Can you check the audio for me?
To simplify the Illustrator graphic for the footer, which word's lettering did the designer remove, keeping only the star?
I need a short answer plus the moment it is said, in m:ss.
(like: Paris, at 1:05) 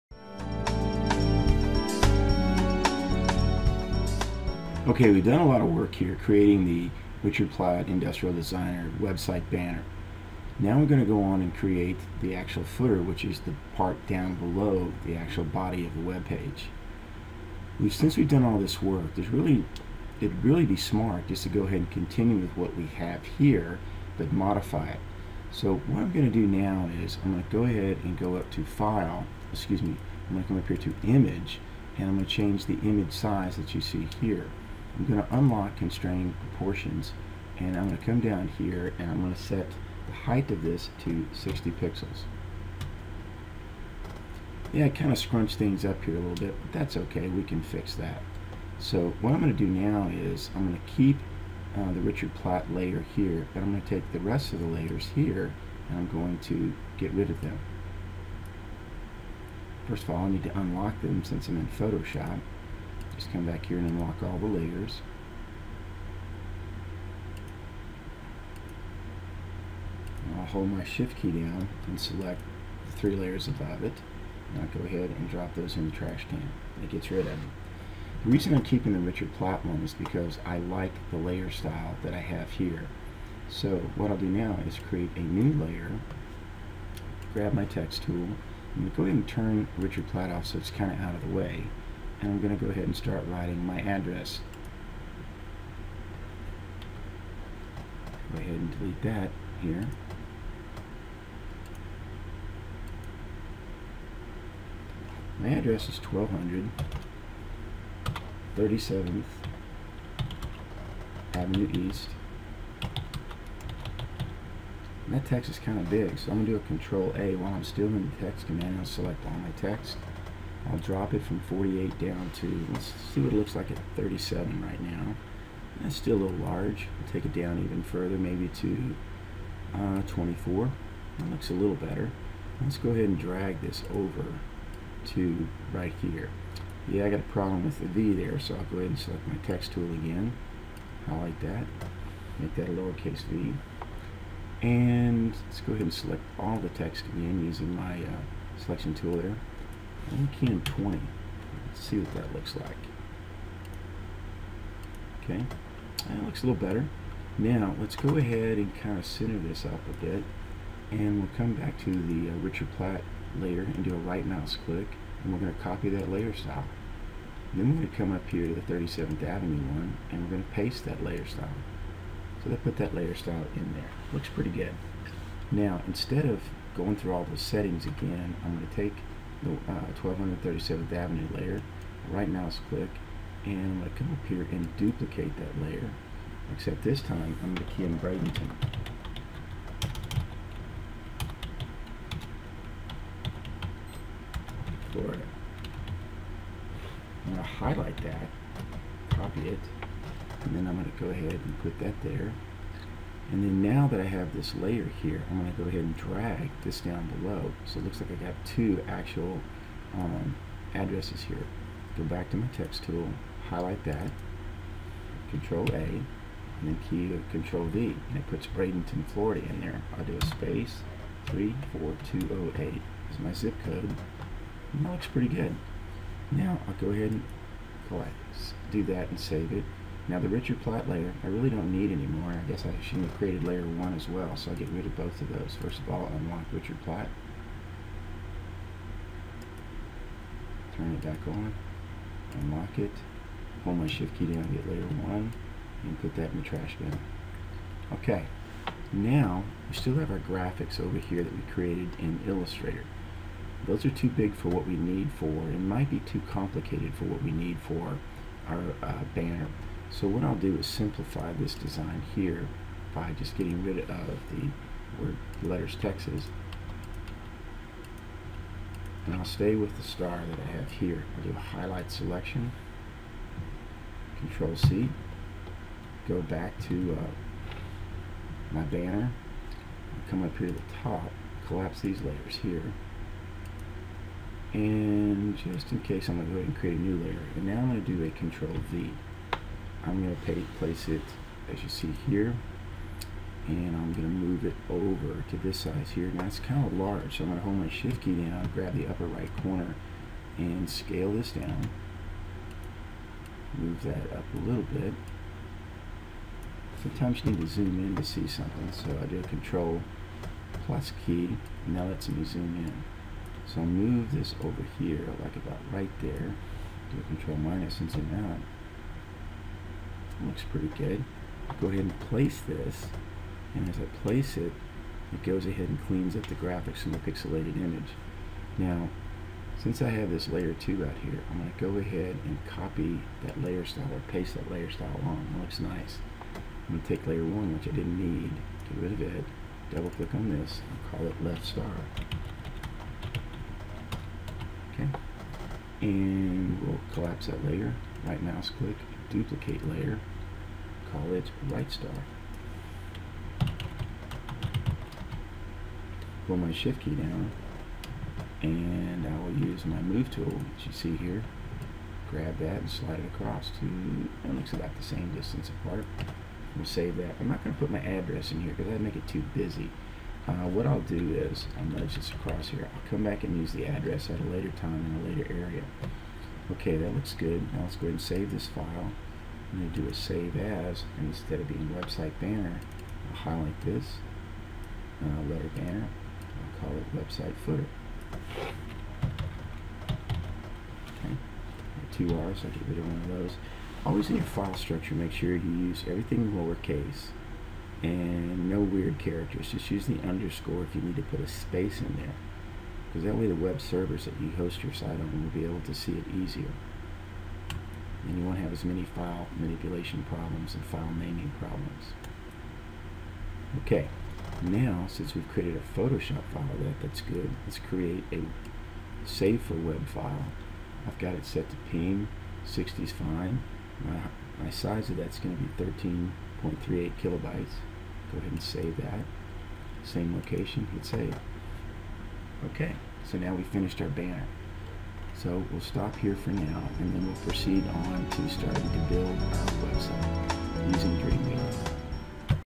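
Texas, at 4:25.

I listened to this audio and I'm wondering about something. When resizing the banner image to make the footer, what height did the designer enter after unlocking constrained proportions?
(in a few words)
60 pixels.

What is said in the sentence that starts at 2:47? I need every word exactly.
Then we're going to come up here to the 37th Avenue one, and we're going to paste that layer style.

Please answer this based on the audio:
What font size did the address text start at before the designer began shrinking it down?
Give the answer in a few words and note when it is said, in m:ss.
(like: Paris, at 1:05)
48, at 2:01.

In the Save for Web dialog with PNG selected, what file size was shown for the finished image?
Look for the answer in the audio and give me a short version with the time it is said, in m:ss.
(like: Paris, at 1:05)
13.38 kilobytes, at 7:06.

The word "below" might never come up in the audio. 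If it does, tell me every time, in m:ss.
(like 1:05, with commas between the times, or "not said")
0:14, 3:27.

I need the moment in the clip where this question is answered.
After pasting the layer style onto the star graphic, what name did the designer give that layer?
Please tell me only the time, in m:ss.
5:41.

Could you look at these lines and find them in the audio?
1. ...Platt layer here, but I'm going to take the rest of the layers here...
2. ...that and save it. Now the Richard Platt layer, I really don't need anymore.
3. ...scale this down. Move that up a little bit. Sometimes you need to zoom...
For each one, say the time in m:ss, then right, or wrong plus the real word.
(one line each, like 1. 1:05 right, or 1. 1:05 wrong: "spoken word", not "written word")
1. 0:52 right
2. 3:48 right
3. 5:00 right.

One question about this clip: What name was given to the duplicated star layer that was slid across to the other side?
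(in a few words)
right star.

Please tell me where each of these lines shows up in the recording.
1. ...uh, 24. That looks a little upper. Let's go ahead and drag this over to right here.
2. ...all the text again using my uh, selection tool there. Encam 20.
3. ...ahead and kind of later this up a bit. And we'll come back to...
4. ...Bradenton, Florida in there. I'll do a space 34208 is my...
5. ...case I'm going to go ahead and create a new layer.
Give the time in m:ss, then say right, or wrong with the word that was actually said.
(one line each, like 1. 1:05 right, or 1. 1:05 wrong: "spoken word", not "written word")
1. 2:09 wrong: "better", not "upper"
2. 2:26 right
3. 2:38 wrong: "center", not "later"
4. 3:38 right
5. 4:45 right.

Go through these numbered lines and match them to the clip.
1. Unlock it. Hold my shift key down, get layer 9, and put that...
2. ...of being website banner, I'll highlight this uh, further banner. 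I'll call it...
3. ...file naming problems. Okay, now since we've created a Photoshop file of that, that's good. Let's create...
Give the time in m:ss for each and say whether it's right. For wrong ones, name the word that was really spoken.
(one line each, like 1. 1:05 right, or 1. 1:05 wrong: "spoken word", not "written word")
1. 4:02 wrong: "1", not "9"
2. 6:21 wrong: "letter", not "further"
3. 6:50 right.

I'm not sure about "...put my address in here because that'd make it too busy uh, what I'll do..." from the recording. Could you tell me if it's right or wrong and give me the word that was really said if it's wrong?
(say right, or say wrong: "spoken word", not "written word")
right.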